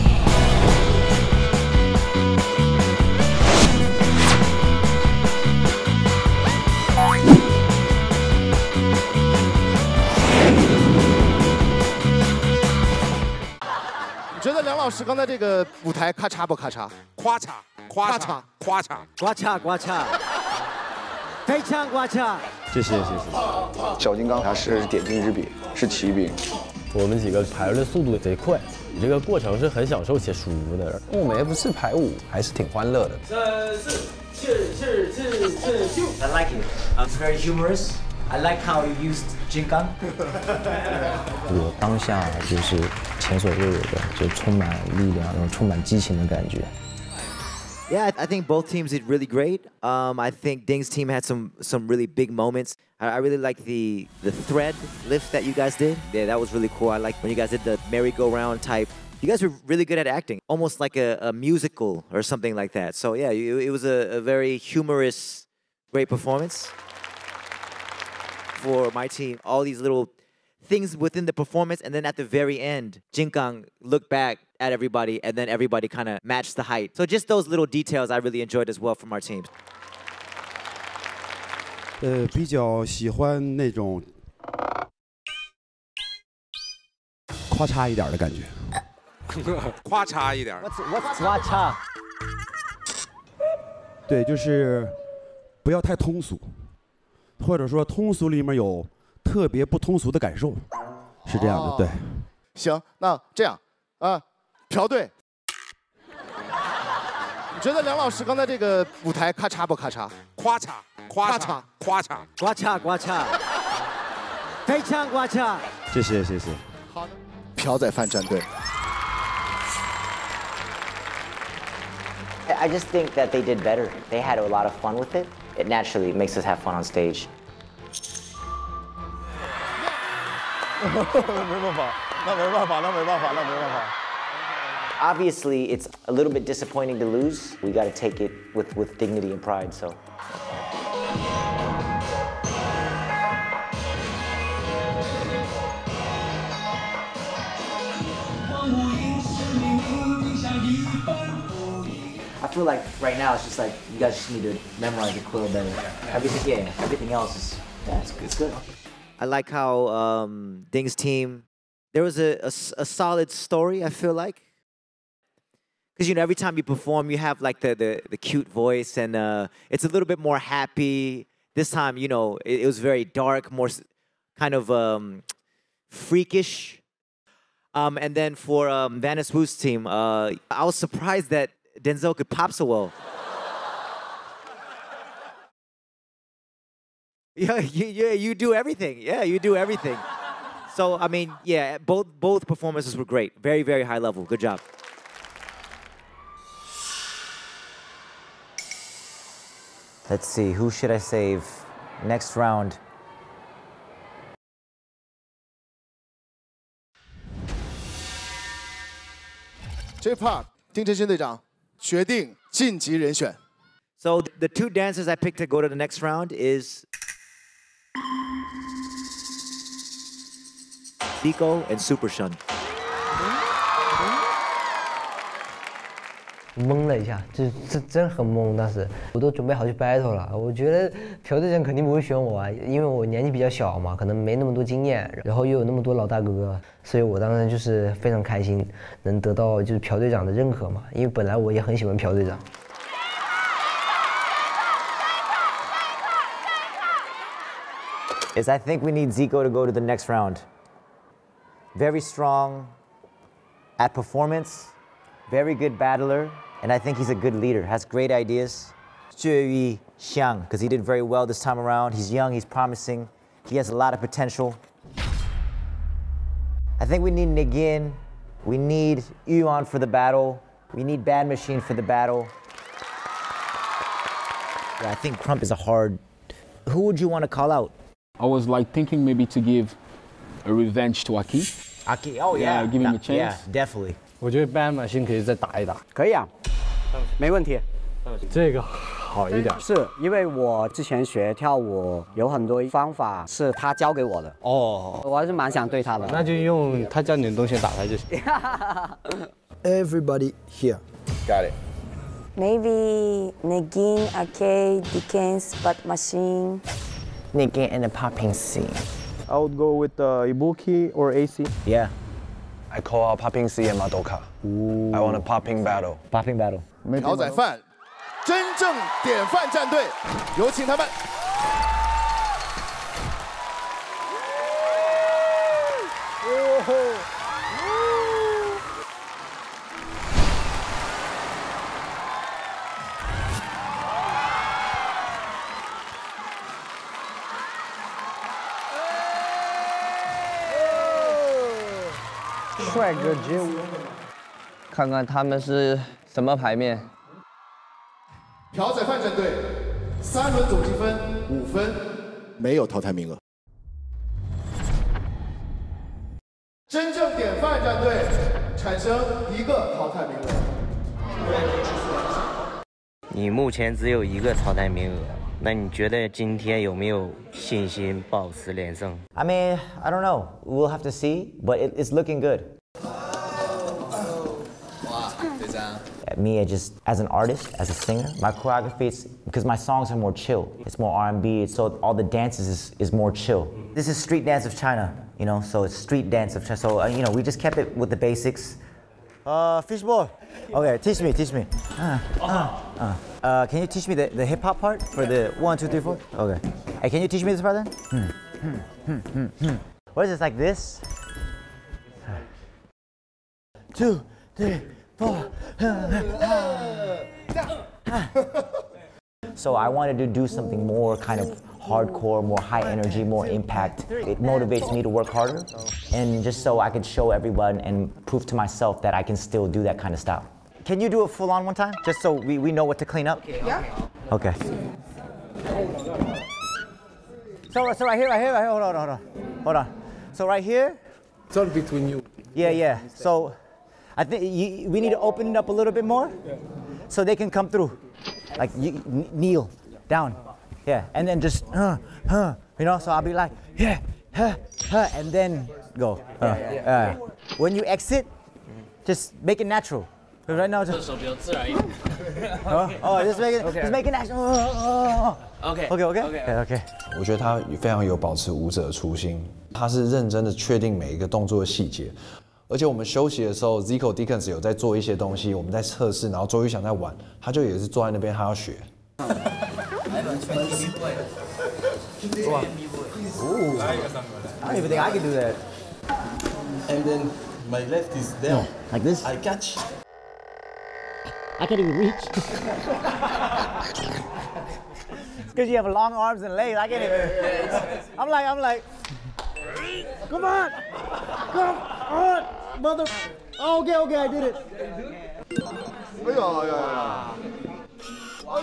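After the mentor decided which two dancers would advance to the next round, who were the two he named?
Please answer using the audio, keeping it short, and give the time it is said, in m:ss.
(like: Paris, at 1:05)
Dico and Super Shun, at 3:41.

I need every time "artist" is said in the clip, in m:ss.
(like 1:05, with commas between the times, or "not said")
6:17.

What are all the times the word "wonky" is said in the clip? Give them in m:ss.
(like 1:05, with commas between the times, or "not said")
not said.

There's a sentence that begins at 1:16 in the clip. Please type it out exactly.
So just those little details I really enjoyed as well from our teams.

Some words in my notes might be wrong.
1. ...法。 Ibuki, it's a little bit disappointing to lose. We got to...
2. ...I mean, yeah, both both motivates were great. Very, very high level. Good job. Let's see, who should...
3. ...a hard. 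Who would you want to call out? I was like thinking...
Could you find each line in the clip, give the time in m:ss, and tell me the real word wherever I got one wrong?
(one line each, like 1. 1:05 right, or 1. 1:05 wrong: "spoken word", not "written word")
1. 2:13 wrong: "Obviously", not "Ibuki"
2. 3:10 wrong: "performances", not "motivates"
3. 4:35 right.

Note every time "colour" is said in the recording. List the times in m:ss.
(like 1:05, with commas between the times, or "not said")
not said.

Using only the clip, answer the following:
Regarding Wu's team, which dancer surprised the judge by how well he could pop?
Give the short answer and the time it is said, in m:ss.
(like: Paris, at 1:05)
Denzel, at 3:01.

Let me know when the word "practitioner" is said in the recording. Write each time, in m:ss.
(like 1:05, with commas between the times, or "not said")
not said.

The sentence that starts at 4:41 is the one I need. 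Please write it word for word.
Aki, oh yeah, yeah give him a chance.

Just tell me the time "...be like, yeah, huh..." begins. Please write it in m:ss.
7:23.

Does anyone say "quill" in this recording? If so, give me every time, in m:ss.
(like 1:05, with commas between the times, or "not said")
2:35.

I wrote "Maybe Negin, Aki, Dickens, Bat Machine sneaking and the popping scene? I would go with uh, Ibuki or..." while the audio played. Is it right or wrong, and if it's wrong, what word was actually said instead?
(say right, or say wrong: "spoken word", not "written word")
right.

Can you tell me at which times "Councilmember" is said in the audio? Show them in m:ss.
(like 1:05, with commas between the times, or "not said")
not said.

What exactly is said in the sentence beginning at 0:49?
Um, I think Ding's team had some some really big moments.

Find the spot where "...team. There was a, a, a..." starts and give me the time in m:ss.
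2:40.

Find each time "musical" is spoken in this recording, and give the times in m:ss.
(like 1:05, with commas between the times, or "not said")
1:01.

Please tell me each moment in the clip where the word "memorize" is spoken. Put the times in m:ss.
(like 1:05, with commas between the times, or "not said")
2:34.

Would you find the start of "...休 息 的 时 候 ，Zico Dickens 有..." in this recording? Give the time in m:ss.
7:42.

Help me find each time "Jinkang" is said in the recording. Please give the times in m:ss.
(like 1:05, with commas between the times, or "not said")
1:13.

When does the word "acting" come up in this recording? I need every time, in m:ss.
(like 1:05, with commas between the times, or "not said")
1:00.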